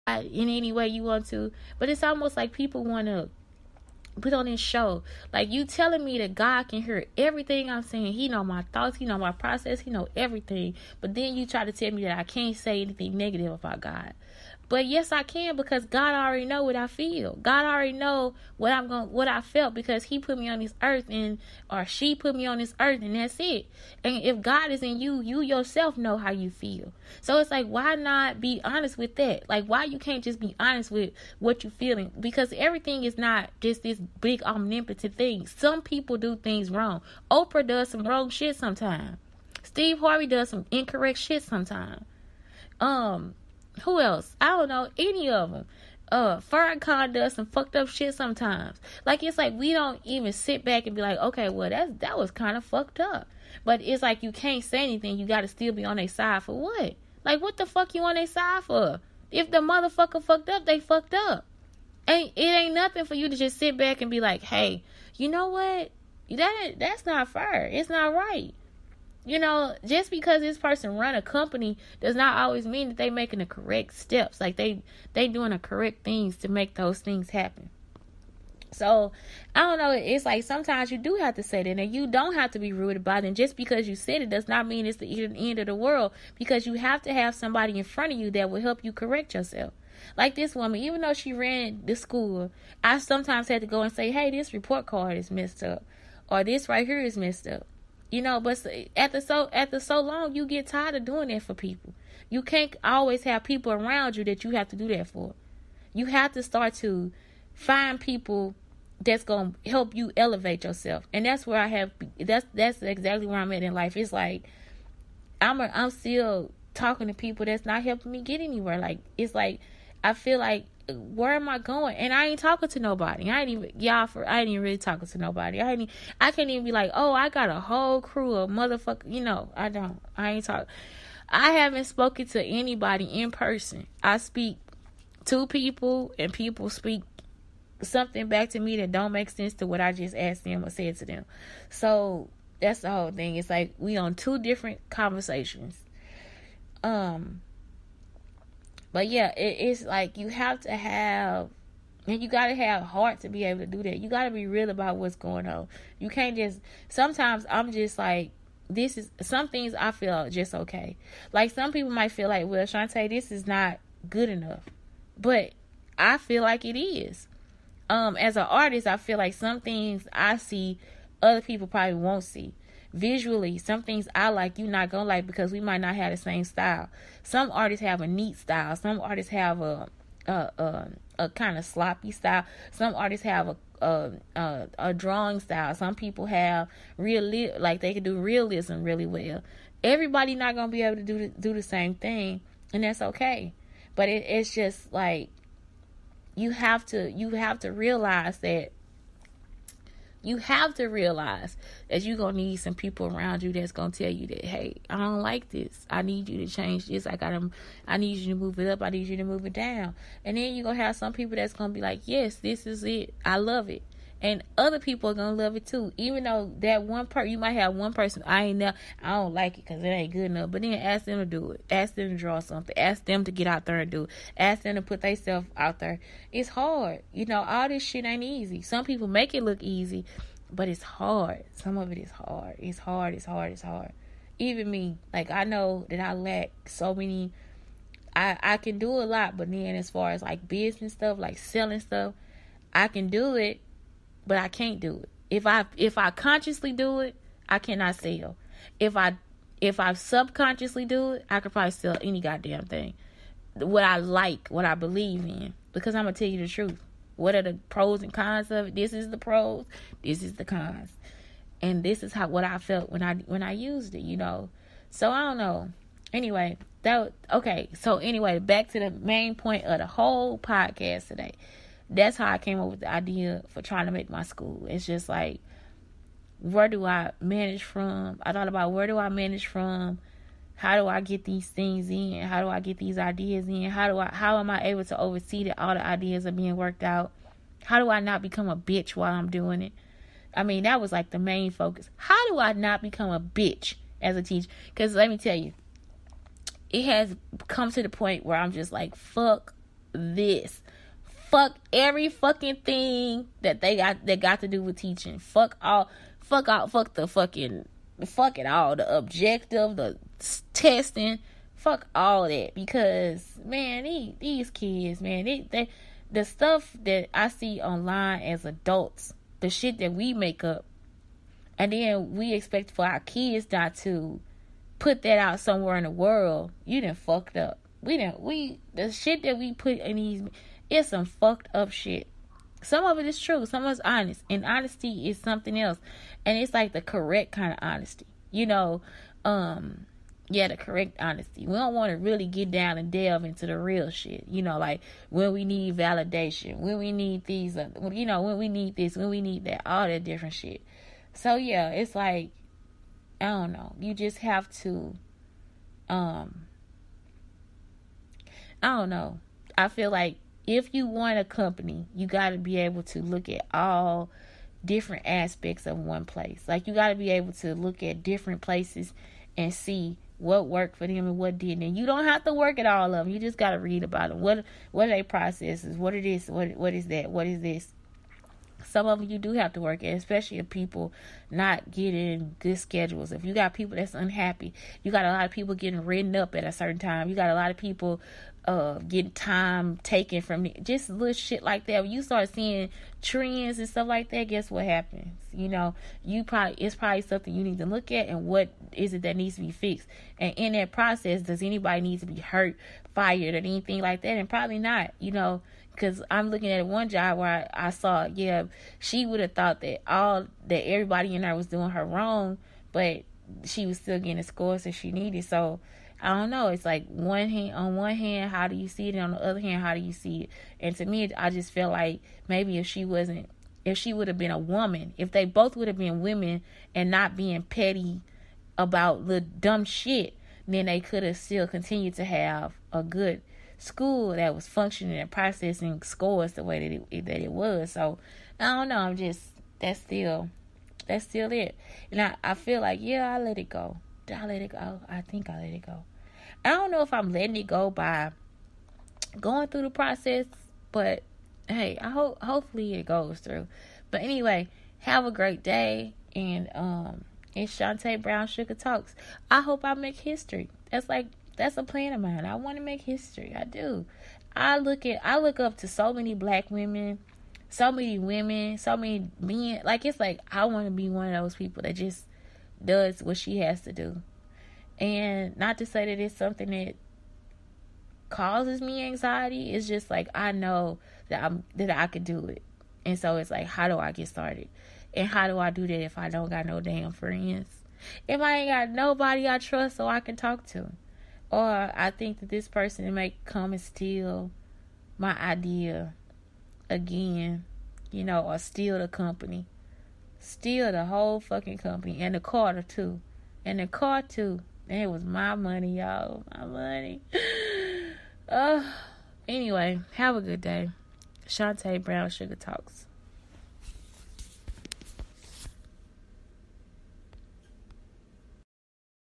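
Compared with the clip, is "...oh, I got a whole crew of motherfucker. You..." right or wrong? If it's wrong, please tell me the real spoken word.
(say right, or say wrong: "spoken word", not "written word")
right.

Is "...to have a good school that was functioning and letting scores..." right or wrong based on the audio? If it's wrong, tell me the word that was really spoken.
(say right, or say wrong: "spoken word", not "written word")
wrong: "processing", not "letting".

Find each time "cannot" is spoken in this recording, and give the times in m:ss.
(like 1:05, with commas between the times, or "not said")
4:07.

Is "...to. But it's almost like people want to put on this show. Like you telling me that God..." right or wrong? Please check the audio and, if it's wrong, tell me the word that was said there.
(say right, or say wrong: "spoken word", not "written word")
right.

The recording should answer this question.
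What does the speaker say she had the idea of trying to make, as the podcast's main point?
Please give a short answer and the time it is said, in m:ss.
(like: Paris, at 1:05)
my school, at 4:34.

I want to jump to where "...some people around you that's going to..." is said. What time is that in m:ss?
3:22.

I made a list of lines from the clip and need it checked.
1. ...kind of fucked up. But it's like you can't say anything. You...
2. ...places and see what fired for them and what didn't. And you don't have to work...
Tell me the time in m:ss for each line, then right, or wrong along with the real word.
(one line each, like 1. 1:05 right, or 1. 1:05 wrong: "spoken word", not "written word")
1. 0:52 right
2. 6:08 wrong: "worked", not "fired".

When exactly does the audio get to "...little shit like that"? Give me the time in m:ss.
6:30.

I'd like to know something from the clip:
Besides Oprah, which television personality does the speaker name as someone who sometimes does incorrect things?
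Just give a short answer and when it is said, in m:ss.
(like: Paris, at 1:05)
Steve Harvey, at 0:39.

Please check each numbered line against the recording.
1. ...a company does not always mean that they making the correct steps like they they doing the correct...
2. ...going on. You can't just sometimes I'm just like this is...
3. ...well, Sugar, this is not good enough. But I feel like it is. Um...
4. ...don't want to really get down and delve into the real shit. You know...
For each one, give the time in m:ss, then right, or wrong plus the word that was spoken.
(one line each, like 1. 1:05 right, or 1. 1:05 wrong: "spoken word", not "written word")
1. 1:11 right
2. 2:35 right
3. 2:42 wrong: "Shantae", not "Sugar"
4. 5:41 right.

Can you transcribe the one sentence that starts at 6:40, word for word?
And in that process, does anybody need to be hurt, fired, or anything like that?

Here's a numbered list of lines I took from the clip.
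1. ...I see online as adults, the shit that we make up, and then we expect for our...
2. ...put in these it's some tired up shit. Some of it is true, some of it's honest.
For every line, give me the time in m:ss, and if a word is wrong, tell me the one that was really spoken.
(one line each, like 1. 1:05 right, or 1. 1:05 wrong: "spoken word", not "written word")
1. 5:17 right
2. 5:29 wrong: "fucked", not "tired".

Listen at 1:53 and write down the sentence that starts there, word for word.
It's like I'm a, I'm still talking to people that's not helping me get anywhere.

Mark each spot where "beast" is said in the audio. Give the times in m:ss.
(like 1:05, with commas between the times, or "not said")
not said.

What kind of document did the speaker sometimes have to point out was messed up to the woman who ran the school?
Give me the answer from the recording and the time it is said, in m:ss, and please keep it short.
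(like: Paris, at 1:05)
report card, at 1:34.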